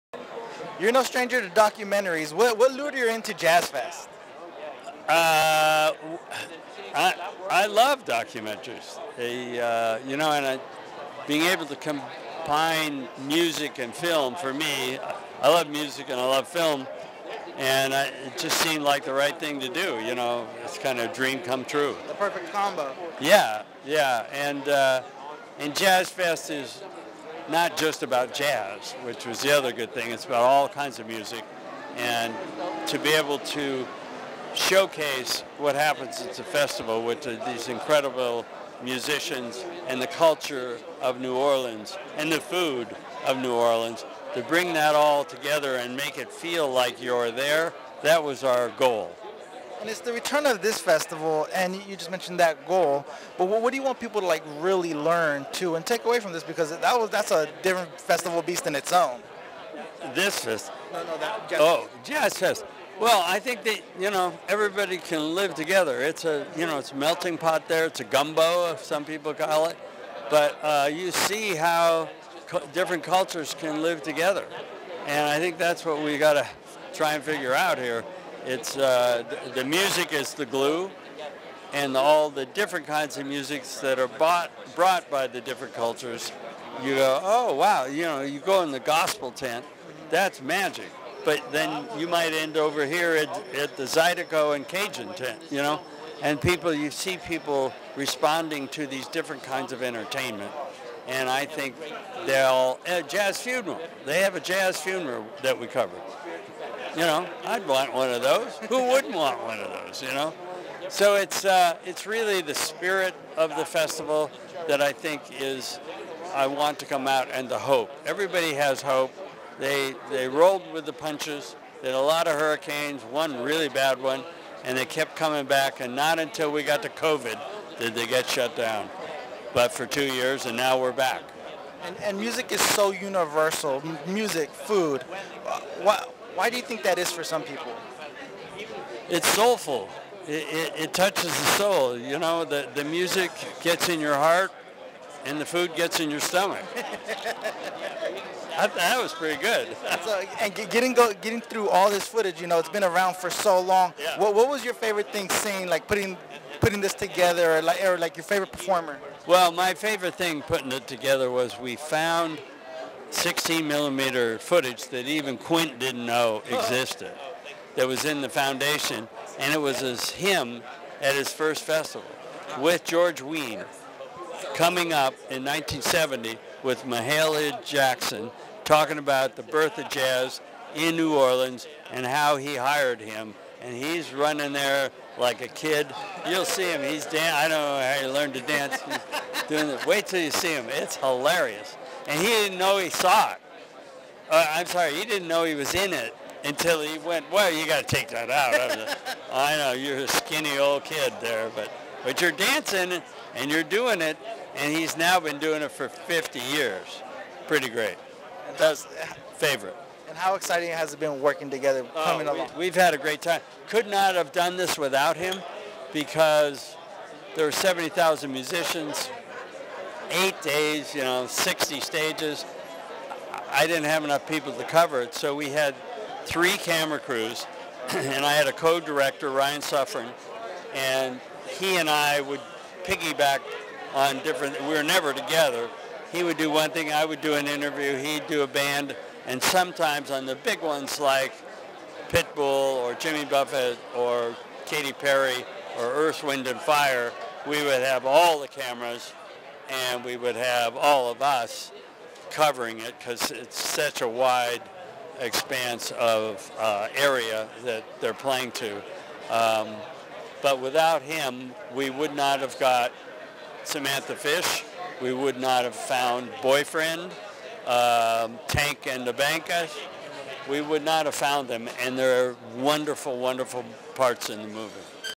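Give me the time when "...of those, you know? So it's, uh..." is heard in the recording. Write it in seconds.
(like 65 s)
109 s.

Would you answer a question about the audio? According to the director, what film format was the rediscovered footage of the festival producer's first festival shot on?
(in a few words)
16 millimeter.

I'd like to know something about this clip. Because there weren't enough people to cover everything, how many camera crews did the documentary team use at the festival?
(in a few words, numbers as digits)
3.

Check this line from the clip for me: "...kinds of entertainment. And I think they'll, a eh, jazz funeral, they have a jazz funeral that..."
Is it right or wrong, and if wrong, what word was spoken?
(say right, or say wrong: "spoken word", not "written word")
right.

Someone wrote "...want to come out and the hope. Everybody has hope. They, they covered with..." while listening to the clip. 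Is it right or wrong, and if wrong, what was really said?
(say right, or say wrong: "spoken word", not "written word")
wrong: "rolled", not "covered".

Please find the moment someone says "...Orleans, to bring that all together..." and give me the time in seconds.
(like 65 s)
43 s.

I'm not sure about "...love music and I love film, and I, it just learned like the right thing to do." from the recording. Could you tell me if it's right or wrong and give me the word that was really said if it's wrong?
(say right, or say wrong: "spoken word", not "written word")
wrong: "seemed", not "learned".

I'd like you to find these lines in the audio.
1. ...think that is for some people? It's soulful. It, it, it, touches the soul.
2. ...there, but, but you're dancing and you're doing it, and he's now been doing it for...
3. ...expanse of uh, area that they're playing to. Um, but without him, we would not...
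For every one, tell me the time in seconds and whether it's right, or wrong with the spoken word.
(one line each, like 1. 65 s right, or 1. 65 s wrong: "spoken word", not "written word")
1. 136 s right
2. 201 s right
3. 255 s right.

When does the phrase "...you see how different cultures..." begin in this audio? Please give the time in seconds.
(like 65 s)
70 s.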